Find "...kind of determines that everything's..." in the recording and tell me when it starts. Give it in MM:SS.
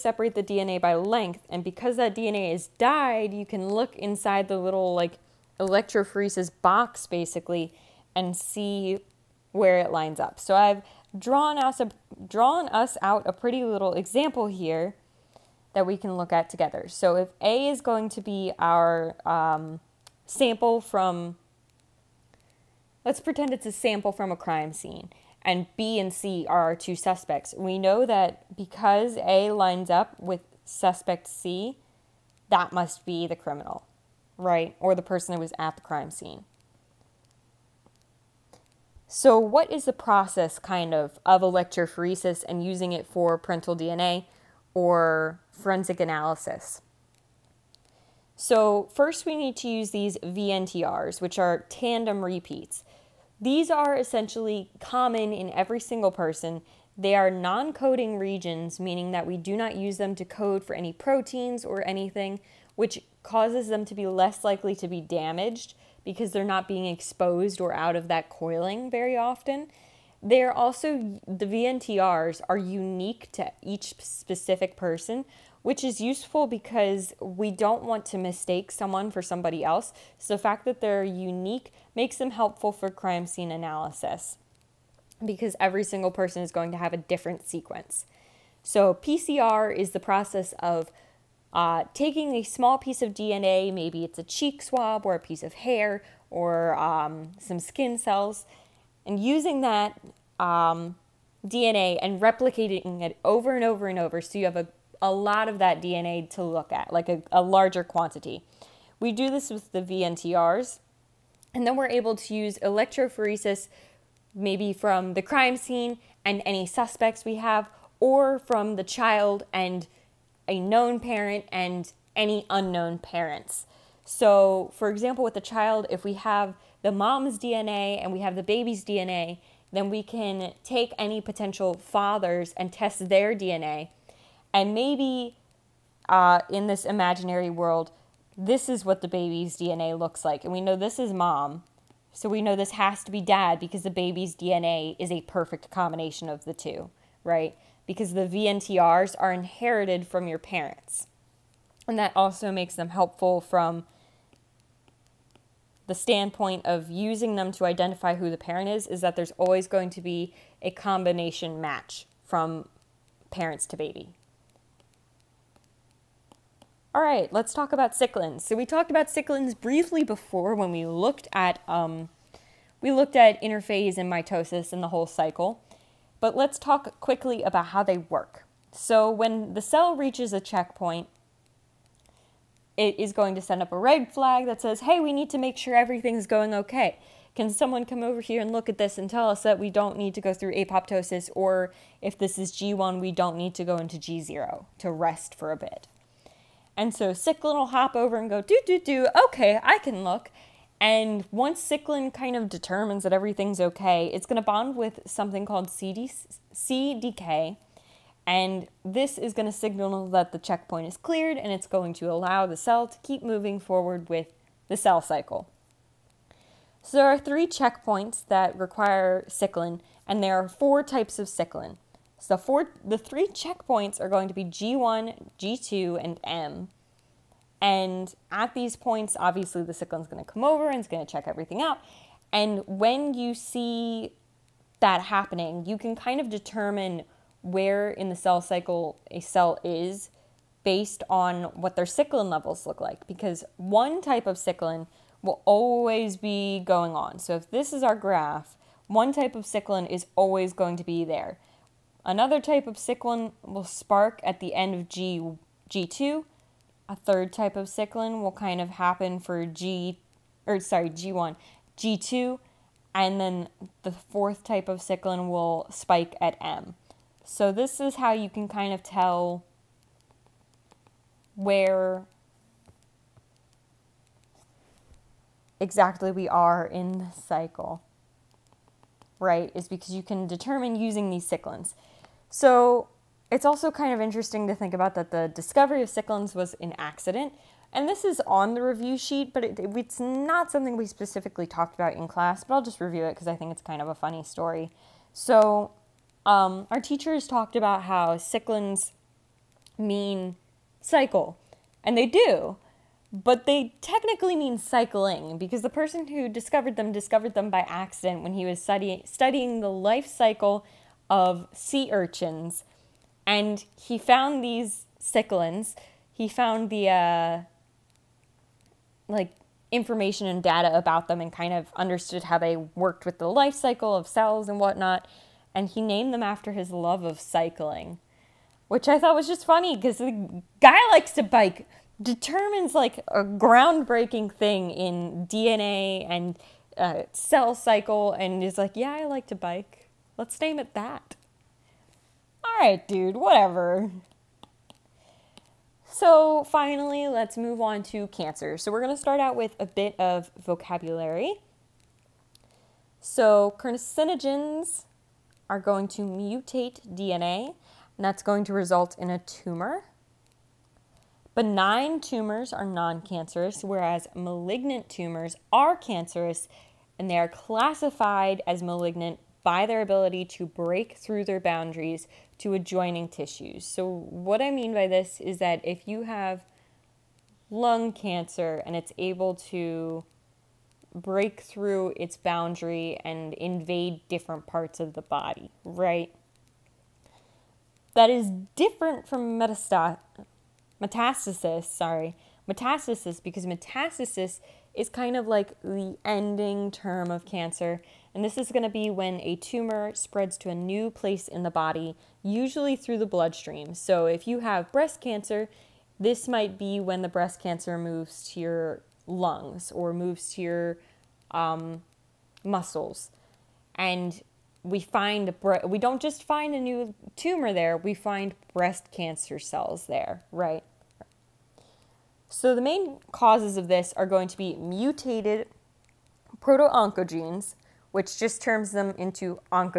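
03:22.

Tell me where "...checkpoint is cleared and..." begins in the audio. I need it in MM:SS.
03:30.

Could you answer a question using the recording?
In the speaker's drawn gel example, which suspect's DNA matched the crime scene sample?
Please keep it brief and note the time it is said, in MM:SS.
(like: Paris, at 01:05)
Suspect C, at 00:30.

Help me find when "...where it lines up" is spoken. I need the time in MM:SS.
00:09.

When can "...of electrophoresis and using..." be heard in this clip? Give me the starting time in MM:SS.
00:41.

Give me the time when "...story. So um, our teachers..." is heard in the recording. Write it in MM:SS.
04:54.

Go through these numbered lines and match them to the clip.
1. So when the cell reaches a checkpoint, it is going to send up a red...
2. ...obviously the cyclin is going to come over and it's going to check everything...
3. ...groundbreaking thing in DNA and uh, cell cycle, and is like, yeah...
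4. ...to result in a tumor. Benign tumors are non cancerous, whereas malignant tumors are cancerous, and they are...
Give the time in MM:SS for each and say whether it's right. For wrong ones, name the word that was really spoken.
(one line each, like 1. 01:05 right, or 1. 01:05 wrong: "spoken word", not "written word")
1. 02:58 right
2. 03:49 right
3. 05:33 right
4. 05:58 right.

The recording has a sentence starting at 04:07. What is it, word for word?
So if this is our graph, one type of cyclin is always going to be there.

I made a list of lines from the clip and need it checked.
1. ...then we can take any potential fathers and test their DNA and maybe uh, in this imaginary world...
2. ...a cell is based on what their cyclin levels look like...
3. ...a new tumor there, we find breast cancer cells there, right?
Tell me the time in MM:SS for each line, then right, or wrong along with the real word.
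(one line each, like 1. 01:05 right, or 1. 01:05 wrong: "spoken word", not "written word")
1. 02:09 right
2. 03:59 right
3. 06:56 right.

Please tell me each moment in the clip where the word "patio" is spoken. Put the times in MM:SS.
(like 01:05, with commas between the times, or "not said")
not said.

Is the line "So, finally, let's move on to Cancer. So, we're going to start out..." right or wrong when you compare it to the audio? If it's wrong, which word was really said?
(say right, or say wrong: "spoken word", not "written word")
right.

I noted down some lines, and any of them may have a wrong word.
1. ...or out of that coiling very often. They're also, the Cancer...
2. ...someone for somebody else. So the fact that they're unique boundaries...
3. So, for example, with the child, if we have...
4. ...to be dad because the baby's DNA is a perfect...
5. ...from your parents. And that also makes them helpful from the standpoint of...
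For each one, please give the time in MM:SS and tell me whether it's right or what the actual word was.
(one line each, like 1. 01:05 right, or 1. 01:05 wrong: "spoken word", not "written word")
1. 01:07 wrong: "VNTRs", not "Cancer"
2. 01:18 wrong: "makes", not "boundaries"
3. 02:04 right
4. 02:23 right
5. 02:30 right.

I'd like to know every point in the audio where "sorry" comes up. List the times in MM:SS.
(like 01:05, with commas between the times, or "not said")
04:20, 06:31.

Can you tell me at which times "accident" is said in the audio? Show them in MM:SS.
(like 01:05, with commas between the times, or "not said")
04:46, 05:07.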